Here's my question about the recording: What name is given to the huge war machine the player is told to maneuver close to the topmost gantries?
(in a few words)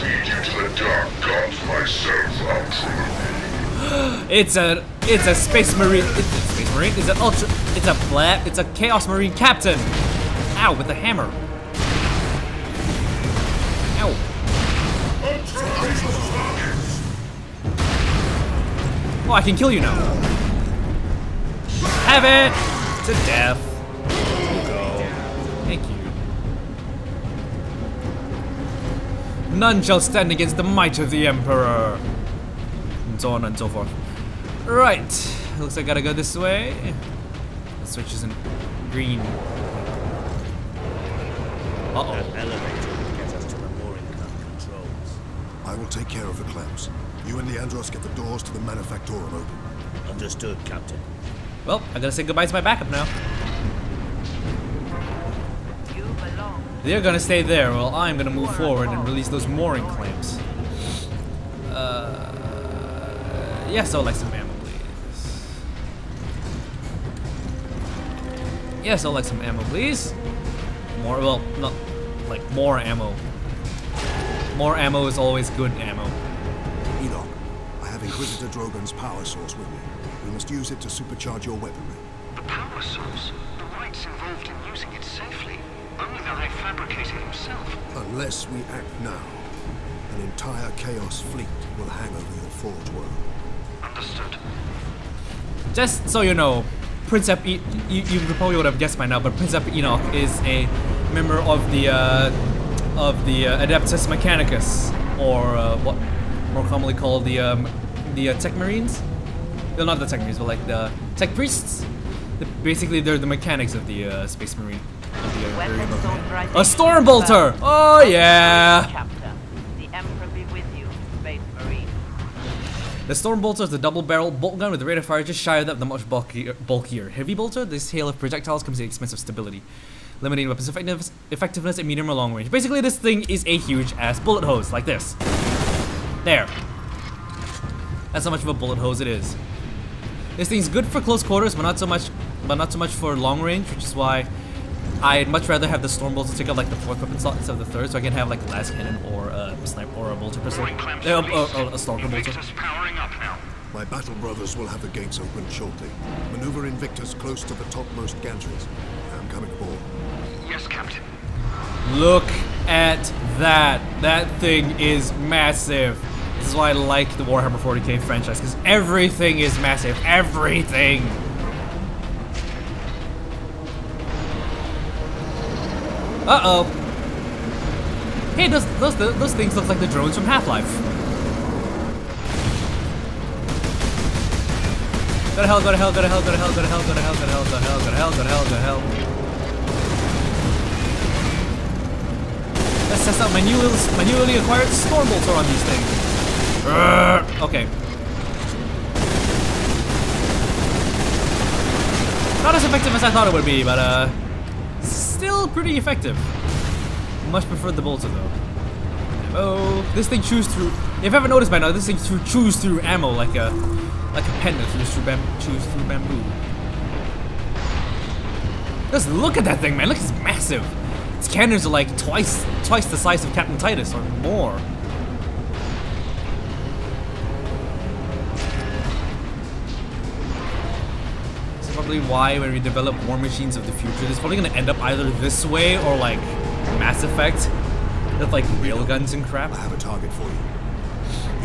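Invictus.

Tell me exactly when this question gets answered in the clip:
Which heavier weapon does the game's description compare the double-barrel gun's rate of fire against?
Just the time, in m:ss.
2:07.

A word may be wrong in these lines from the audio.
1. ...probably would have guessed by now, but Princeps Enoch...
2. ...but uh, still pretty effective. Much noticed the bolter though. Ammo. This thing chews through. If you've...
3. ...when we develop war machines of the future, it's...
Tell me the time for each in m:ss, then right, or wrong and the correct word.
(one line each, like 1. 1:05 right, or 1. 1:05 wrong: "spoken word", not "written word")
1. 1:38 right
2. 3:23 wrong: "preferred", not "noticed"
3. 3:52 right.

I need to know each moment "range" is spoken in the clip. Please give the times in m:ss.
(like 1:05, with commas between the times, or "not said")
2:12, 2:23.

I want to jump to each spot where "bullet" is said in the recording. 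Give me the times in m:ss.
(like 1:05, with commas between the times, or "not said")
2:14, 2:18.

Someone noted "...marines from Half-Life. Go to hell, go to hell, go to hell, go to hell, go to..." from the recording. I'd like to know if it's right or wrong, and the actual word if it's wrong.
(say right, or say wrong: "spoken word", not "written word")
wrong: "drones", not "marines".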